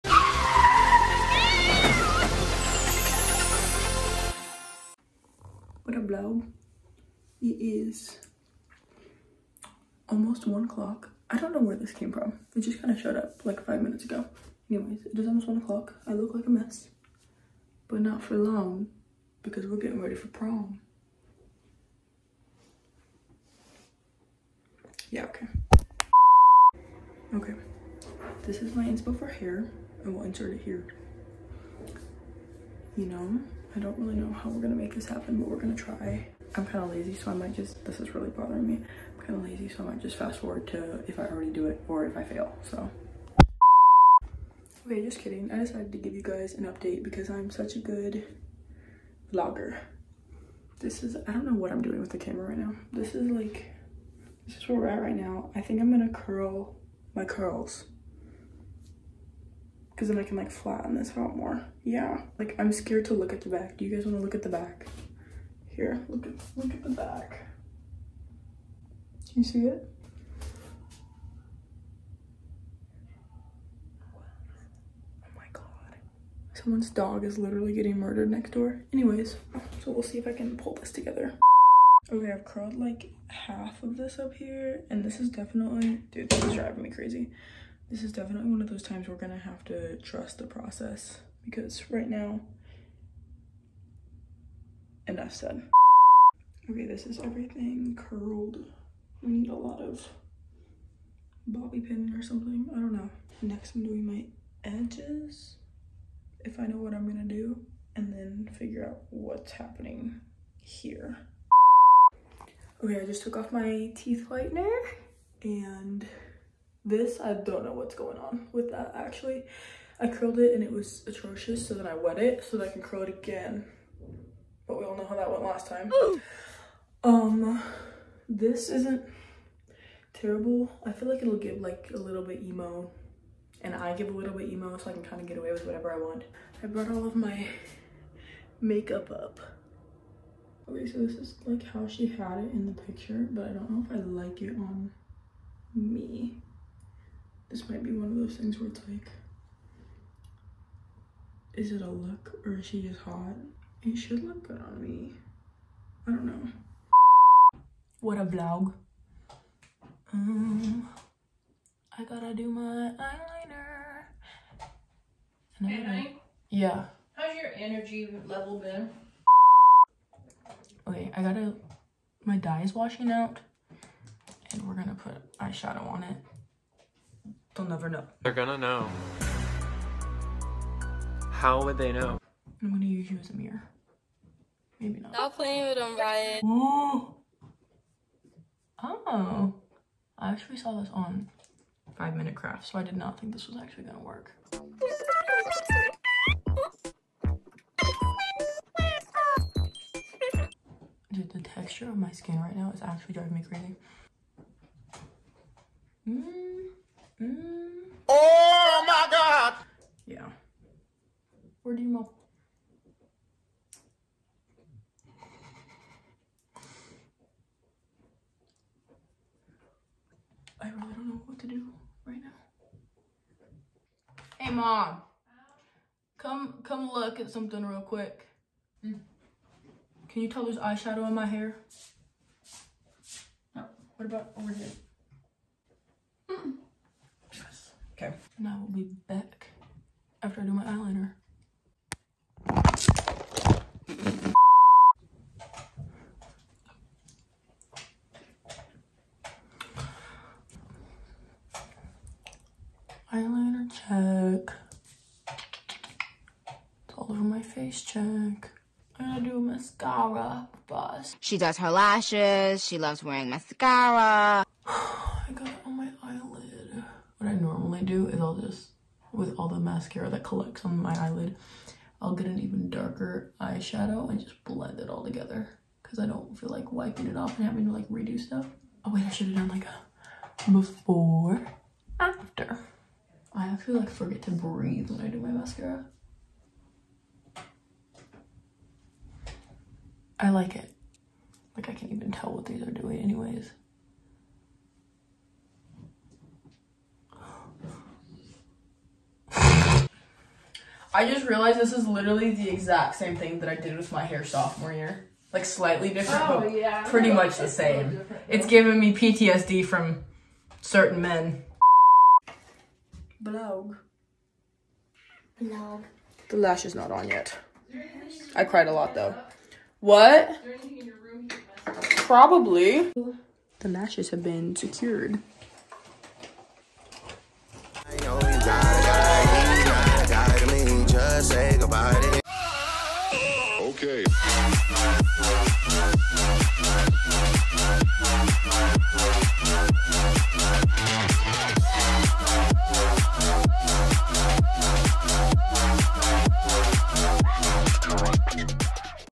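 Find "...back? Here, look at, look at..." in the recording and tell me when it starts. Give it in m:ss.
1:04.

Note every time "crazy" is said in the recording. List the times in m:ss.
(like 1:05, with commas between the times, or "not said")
1:26, 3:23.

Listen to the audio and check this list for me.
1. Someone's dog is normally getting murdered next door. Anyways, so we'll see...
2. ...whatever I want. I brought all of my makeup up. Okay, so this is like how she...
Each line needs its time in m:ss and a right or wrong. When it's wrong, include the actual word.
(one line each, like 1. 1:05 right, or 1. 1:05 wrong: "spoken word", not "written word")
1. 1:16 wrong: "literally", not "normally"
2. 2:15 right.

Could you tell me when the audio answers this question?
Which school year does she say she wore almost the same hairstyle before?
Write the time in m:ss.
5:04.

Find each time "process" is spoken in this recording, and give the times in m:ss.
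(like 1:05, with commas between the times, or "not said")
1:30.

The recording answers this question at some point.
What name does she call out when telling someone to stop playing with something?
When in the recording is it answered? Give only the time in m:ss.
3:05.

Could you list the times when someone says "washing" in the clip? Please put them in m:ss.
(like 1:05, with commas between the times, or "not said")
2:52.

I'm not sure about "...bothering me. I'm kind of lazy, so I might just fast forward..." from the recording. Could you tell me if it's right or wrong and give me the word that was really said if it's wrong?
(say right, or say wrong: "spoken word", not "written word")
right.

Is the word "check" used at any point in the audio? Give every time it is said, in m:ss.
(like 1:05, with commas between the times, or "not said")
4:13, 4:17.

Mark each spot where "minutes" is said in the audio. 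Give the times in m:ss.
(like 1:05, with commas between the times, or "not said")
0:13, 3:12.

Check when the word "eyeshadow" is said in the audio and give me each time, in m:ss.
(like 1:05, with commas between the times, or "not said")
2:55, 3:50, 4:33.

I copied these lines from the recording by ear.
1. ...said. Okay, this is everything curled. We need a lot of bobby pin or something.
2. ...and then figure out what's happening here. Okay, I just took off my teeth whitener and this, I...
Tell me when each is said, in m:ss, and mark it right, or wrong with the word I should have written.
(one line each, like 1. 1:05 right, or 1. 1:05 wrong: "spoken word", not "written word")
1. 1:35 right
2. 1:47 right.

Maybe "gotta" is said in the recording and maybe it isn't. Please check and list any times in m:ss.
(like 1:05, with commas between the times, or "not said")
2:42, 2:51.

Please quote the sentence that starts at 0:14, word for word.
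Anyways, it is almost one o'clock.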